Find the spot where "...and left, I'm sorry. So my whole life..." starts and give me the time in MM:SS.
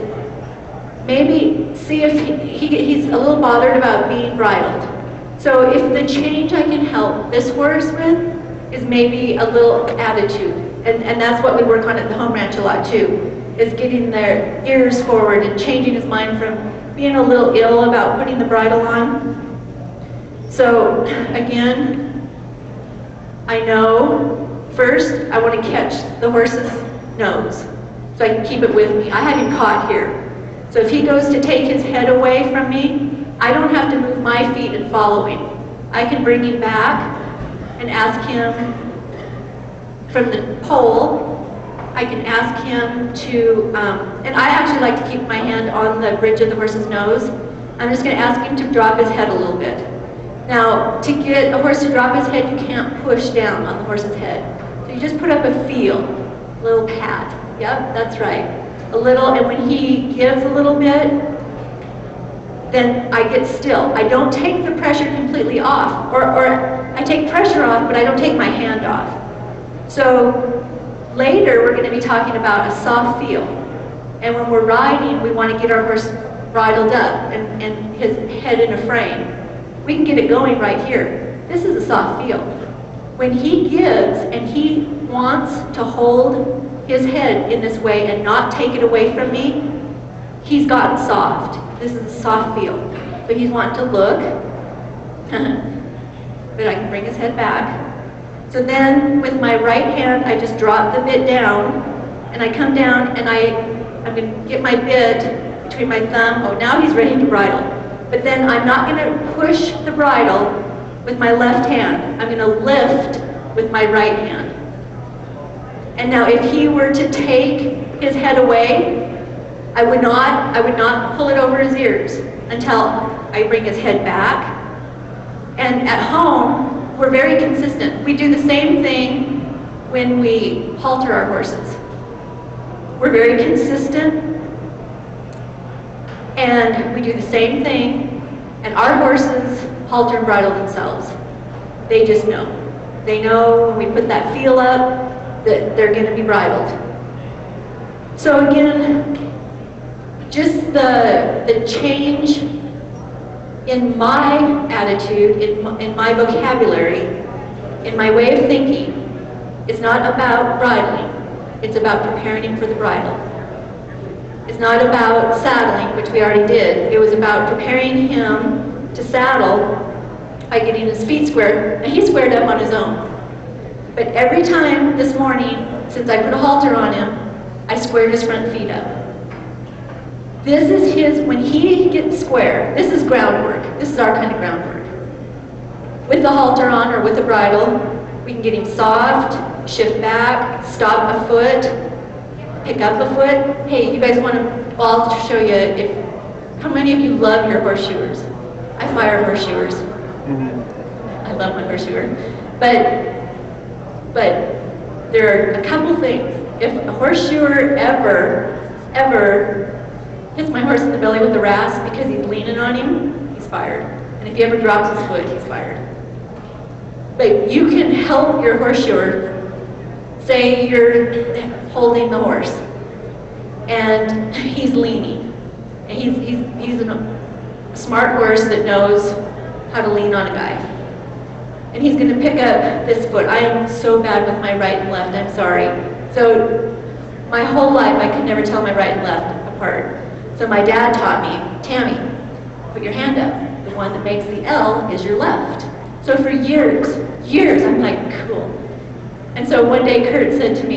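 03:54.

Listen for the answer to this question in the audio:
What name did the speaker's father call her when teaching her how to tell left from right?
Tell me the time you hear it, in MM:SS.
04:01.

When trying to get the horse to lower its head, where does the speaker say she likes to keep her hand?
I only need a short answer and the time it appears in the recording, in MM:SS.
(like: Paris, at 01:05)
Bridge of the horse's nose, at 00:46.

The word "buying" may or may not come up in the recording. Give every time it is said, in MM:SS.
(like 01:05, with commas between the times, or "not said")
not said.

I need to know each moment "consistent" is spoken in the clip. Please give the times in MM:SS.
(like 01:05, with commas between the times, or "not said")
02:07, 02:13.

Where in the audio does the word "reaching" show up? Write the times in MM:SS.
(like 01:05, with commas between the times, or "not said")
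not said.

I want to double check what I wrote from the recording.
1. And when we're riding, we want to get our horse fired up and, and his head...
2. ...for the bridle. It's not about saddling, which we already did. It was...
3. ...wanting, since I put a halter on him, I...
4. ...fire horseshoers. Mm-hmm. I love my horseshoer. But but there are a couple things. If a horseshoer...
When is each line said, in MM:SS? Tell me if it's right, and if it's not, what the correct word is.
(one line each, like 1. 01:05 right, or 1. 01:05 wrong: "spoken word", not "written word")
1. 01:14 wrong: "bridled", not "fired"
2. 02:42 right
3. 02:55 wrong: "morning", not "wanting"
4. 03:18 right.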